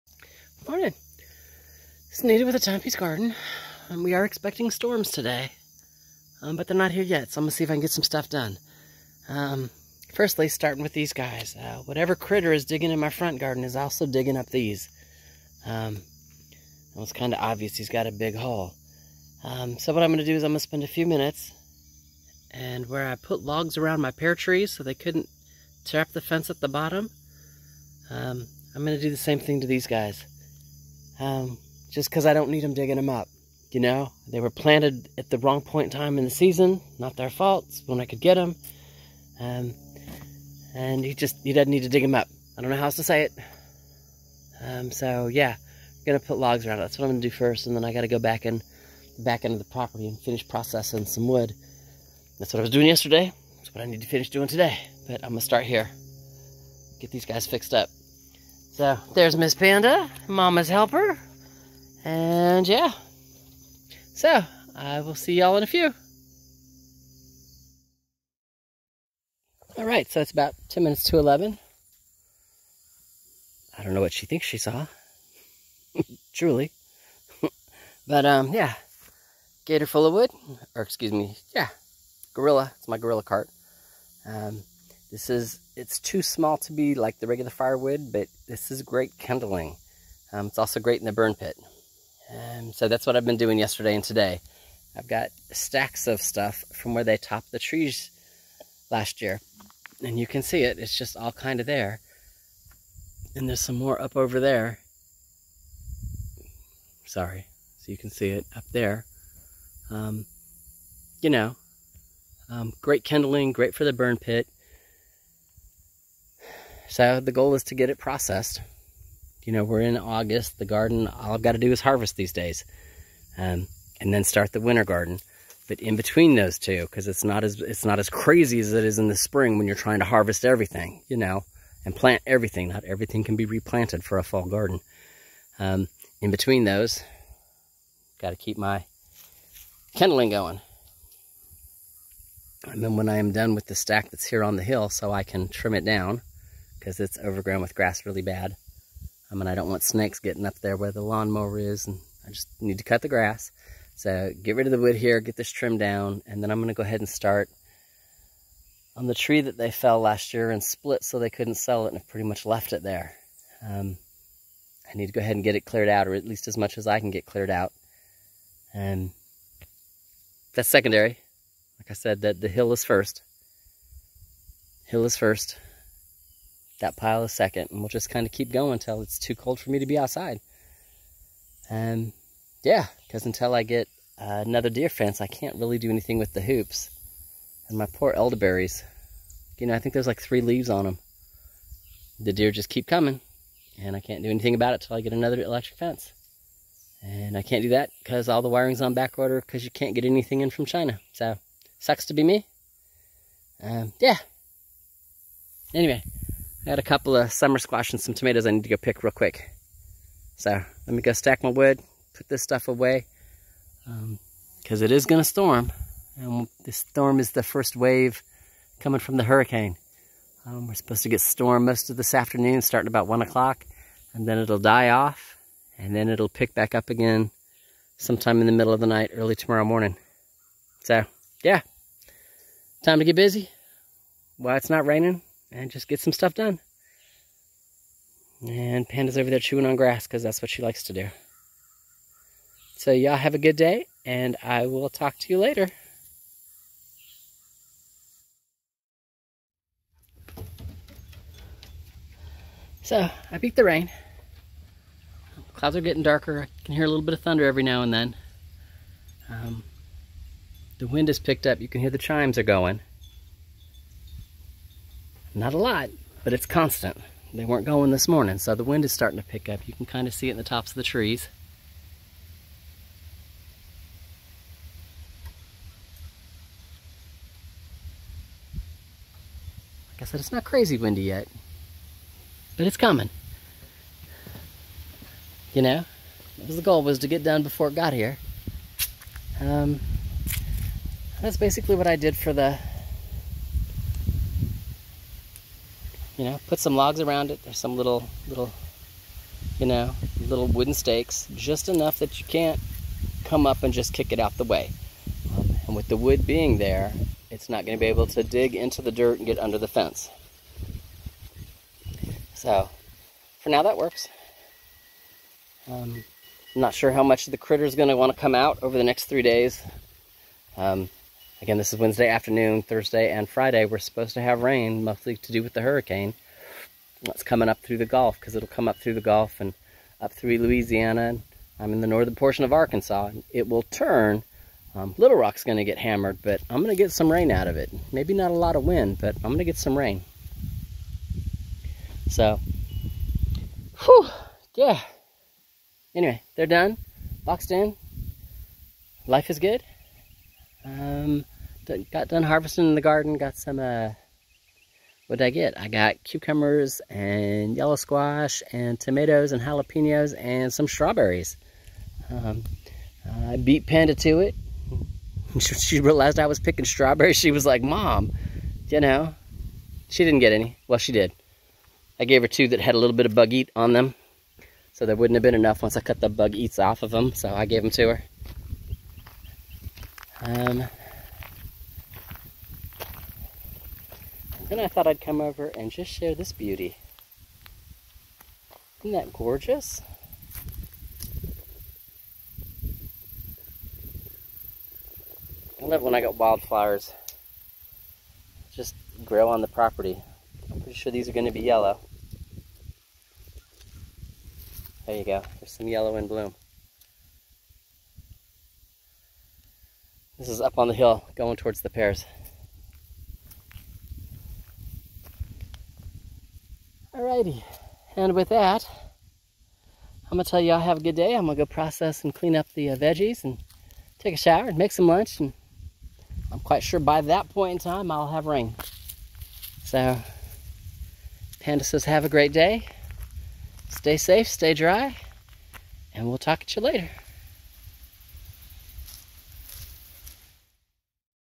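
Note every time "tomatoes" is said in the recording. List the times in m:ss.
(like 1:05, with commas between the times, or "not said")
3:28, 5:58.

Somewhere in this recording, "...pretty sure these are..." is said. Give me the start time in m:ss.
6:40.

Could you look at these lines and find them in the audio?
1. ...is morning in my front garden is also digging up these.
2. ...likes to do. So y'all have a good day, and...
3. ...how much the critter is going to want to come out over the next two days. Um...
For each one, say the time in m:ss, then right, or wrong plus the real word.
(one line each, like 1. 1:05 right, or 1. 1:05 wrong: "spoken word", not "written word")
1. 0:12 wrong: "digging", not "morning"
2. 4:00 right
3. 5:16 wrong: "three", not "two".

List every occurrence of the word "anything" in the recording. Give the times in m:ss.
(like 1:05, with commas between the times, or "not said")
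3:05, 3:14, 3:20.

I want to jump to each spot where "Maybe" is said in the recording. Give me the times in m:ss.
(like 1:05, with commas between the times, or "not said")
5:37.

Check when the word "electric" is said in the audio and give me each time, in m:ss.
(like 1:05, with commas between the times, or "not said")
3:15.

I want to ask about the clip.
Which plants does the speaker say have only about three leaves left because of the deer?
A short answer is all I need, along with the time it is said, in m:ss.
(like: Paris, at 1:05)
Elderberries, at 3:08.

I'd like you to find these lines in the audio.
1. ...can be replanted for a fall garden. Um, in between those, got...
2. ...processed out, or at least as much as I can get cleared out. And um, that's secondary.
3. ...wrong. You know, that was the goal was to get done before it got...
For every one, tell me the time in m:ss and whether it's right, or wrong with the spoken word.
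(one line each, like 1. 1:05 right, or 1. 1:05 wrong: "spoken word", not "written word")
1. 2:13 right
2. 2:45 wrong: "cleared", not "processed"
3. 4:42 wrong: "coming", not "wrong".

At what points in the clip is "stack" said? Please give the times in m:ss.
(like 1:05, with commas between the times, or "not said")
1:35, 2:23, 3:31.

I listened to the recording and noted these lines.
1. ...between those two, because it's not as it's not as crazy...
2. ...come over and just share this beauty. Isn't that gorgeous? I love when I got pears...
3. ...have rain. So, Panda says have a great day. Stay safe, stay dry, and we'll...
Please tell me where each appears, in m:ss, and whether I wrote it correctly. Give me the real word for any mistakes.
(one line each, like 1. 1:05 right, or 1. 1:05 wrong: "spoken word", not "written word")
1. 2:05 right
2. 6:24 wrong: "wildflowers", not "pears"
3. 7:08 right.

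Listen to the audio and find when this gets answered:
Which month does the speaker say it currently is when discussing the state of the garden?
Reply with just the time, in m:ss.
1:59.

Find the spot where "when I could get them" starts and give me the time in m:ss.
0:37.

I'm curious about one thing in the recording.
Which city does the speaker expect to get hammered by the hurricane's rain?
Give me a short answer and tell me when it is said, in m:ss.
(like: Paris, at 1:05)
Little Rock, at 5:34.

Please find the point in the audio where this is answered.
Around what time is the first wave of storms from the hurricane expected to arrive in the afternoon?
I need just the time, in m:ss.
3:43.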